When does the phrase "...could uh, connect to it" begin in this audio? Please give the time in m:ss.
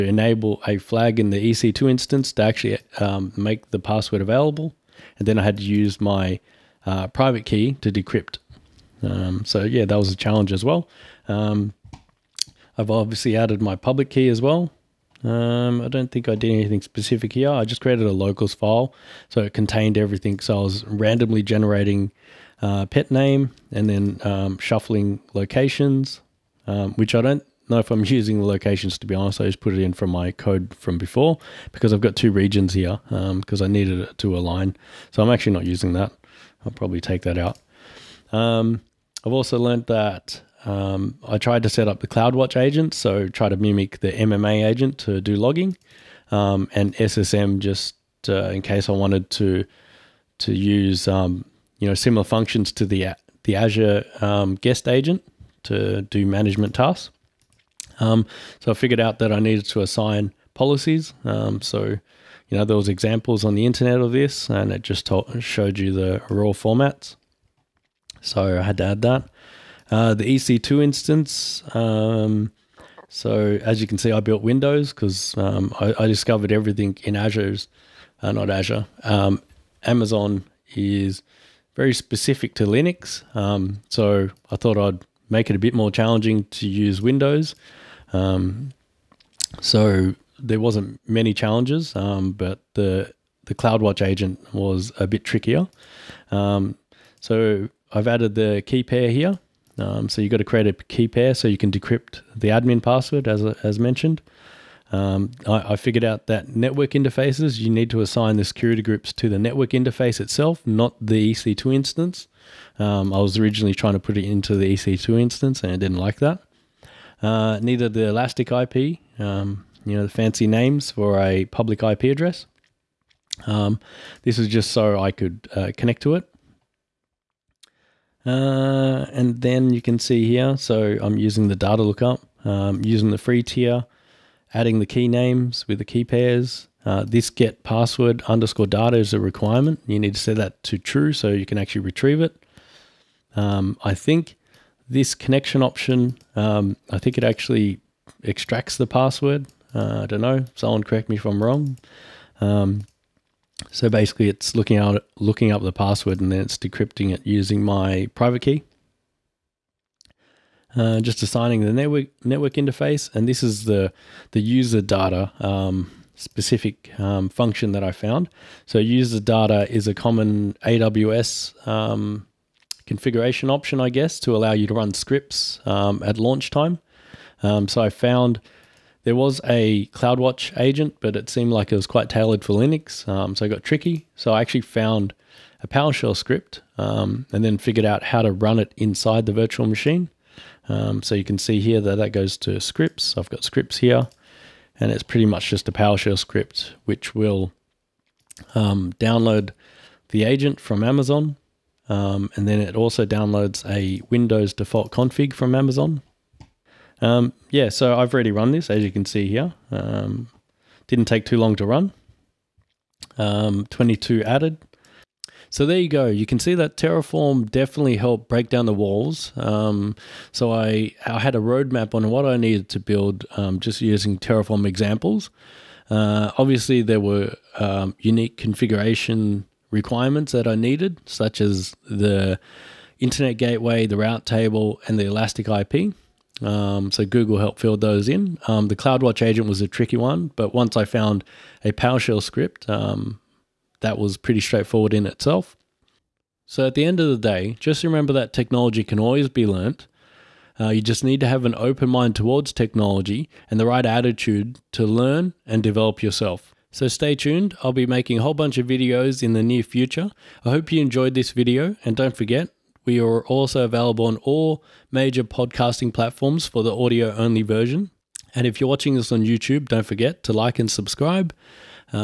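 2:05.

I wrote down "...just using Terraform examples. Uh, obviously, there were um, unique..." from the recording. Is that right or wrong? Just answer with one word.
right.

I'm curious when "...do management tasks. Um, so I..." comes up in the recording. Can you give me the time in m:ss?
0:56.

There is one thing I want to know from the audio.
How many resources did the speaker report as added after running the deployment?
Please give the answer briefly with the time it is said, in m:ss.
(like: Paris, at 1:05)
22, at 3:33.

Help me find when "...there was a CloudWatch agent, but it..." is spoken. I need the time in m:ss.
2:59.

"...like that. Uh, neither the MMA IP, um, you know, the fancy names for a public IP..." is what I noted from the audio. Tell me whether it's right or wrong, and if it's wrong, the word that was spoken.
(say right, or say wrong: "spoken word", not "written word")
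wrong: "Elastic", not "MMA".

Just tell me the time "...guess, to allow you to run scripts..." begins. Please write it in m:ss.
2:53.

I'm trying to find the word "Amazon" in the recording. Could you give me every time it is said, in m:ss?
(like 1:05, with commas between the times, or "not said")
1:19, 3:20, 3:25.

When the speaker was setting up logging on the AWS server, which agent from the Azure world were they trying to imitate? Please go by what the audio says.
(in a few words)
MMA agent.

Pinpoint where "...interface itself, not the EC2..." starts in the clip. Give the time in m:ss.
1:49.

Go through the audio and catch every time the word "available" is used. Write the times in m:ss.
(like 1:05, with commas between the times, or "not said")
0:04, 4:23.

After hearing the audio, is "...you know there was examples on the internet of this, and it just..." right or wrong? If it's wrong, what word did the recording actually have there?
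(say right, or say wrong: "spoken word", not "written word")
right.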